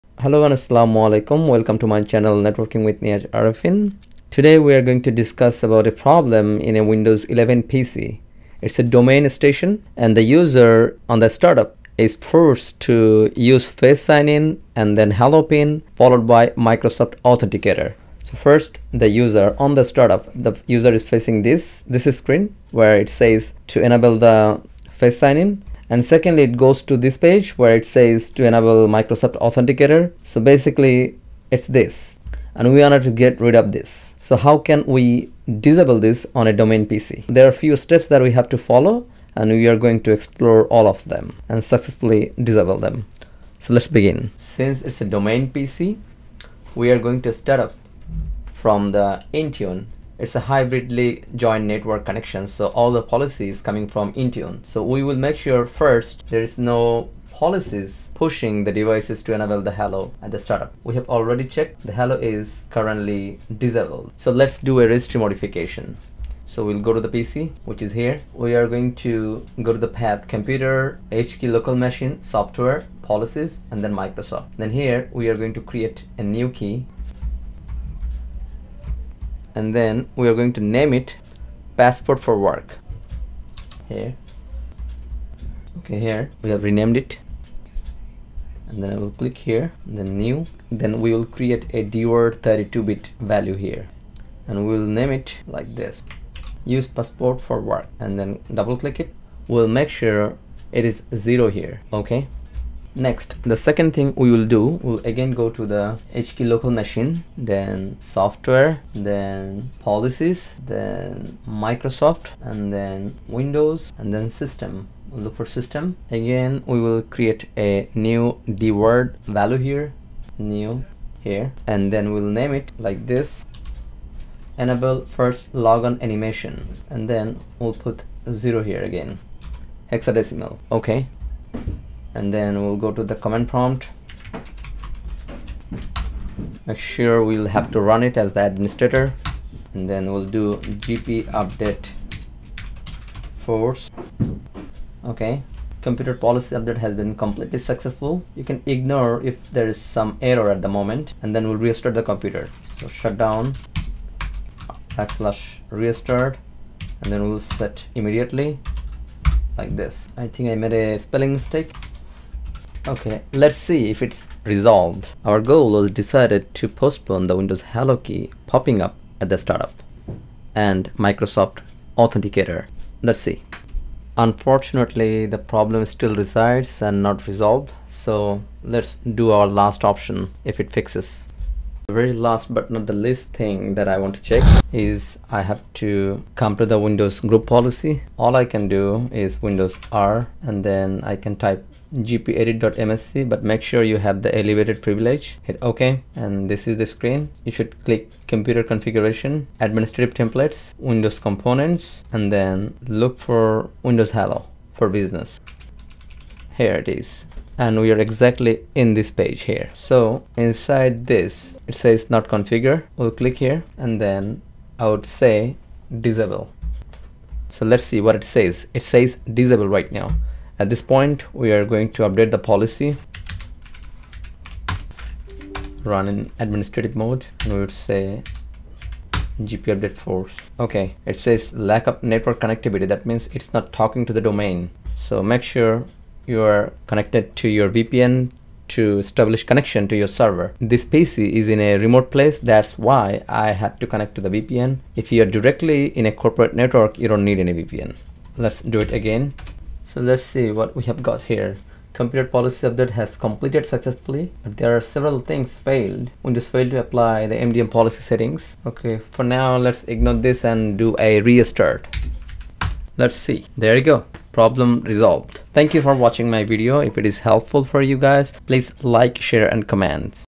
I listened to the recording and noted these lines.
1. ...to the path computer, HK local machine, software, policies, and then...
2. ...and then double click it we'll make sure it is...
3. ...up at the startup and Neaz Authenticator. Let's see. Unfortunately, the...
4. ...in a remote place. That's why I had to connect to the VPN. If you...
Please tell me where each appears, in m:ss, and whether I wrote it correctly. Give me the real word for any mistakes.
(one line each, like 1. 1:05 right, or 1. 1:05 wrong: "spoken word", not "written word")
1. 1:09 right
2. 1:37 right
3. 2:48 wrong: "Microsoft", not "Neaz"
4. 4:01 right.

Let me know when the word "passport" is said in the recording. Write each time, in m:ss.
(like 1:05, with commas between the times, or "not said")
1:21, 1:36.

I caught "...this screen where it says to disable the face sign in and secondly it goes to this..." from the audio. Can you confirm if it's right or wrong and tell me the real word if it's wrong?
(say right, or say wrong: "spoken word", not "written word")
wrong: "enable", not "disable".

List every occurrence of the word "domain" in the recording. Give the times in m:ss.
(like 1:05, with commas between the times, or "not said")
0:08, 0:36, 0:45, 3:54.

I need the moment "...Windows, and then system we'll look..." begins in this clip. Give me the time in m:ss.
1:53.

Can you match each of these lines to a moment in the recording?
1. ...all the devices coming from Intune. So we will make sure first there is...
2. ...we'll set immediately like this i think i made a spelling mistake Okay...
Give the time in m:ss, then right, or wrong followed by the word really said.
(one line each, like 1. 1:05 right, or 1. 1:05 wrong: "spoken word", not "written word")
1. 0:52 wrong: "policies", not "devices"
2. 2:37 right.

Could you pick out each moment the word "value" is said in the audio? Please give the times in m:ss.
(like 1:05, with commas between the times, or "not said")
1:33, 1:59.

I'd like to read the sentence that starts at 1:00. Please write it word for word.
We have already checked the hello is currently disabled.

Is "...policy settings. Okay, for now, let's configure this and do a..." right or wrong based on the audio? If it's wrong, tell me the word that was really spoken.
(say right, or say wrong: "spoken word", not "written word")
wrong: "ignore", not "configure".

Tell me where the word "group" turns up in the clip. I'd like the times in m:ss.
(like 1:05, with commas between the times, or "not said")
3:07.